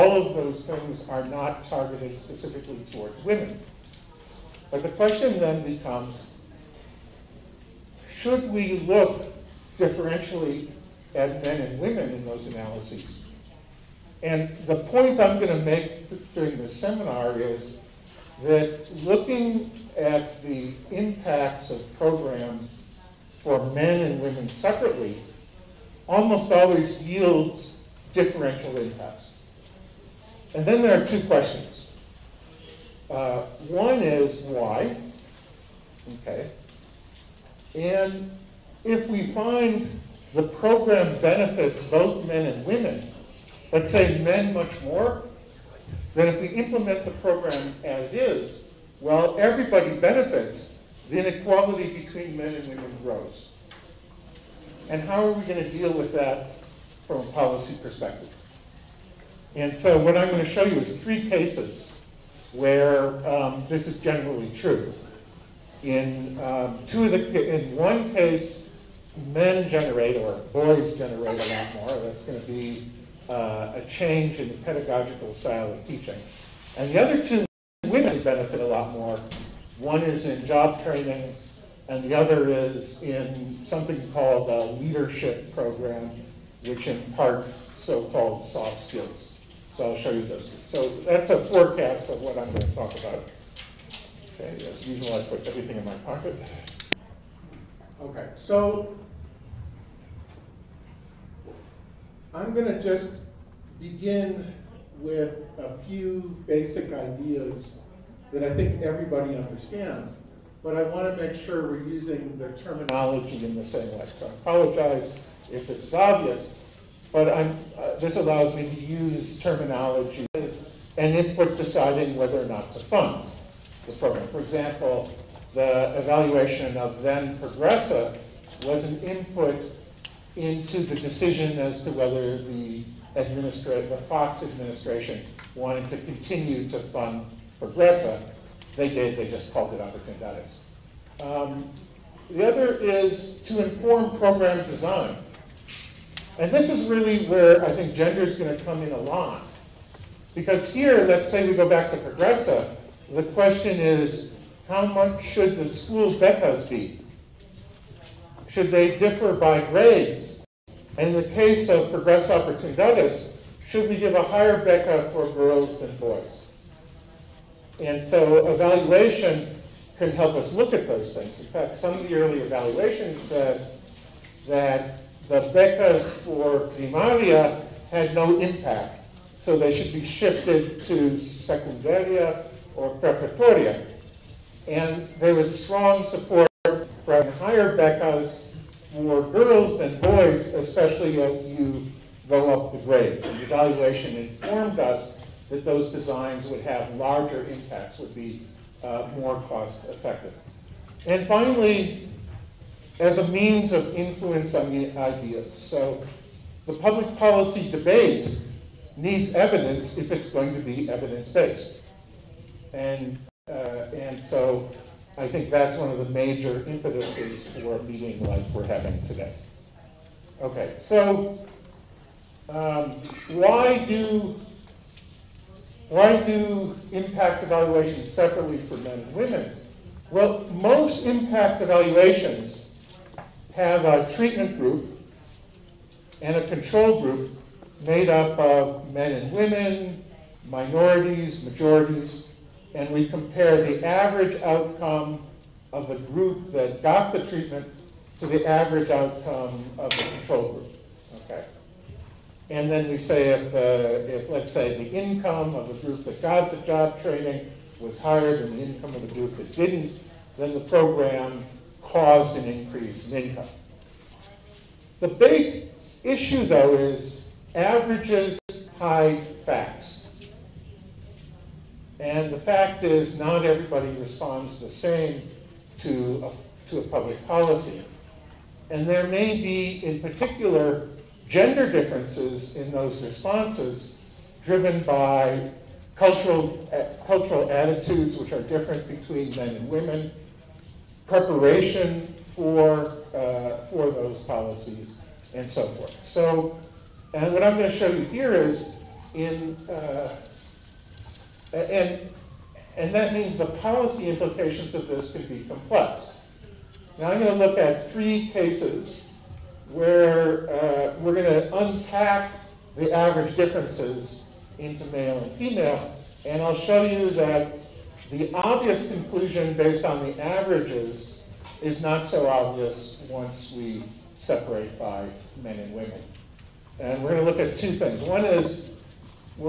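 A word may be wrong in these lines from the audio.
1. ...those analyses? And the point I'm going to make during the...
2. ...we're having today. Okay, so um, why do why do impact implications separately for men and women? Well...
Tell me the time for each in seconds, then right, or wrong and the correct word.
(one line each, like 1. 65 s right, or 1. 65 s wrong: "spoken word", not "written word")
1. 12 s right
2. 218 s wrong: "evaluations", not "implications".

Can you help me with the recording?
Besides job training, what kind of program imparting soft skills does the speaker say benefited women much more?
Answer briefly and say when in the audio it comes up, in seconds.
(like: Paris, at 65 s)
leadership program, at 84 s.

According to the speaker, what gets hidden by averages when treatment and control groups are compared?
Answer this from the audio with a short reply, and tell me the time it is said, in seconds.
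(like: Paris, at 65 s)
facts, at 267 s.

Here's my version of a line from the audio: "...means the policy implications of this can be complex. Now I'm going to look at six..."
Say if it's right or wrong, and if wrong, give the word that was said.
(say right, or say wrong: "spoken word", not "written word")
wrong: "three", not "six".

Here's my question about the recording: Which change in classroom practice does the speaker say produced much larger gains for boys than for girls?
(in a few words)
pedagogical style of teaching.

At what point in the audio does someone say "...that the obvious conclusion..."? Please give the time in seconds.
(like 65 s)
317 s.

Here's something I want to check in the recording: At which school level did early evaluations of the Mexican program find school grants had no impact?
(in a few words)
primaria.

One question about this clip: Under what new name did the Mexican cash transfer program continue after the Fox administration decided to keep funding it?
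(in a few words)
Opportunities.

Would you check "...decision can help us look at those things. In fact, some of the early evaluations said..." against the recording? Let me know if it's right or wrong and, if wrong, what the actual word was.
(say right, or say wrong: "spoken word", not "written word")
wrong: "evaluation", not "decision".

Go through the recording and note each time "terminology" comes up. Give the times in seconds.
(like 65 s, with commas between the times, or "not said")
112 s, 119 s.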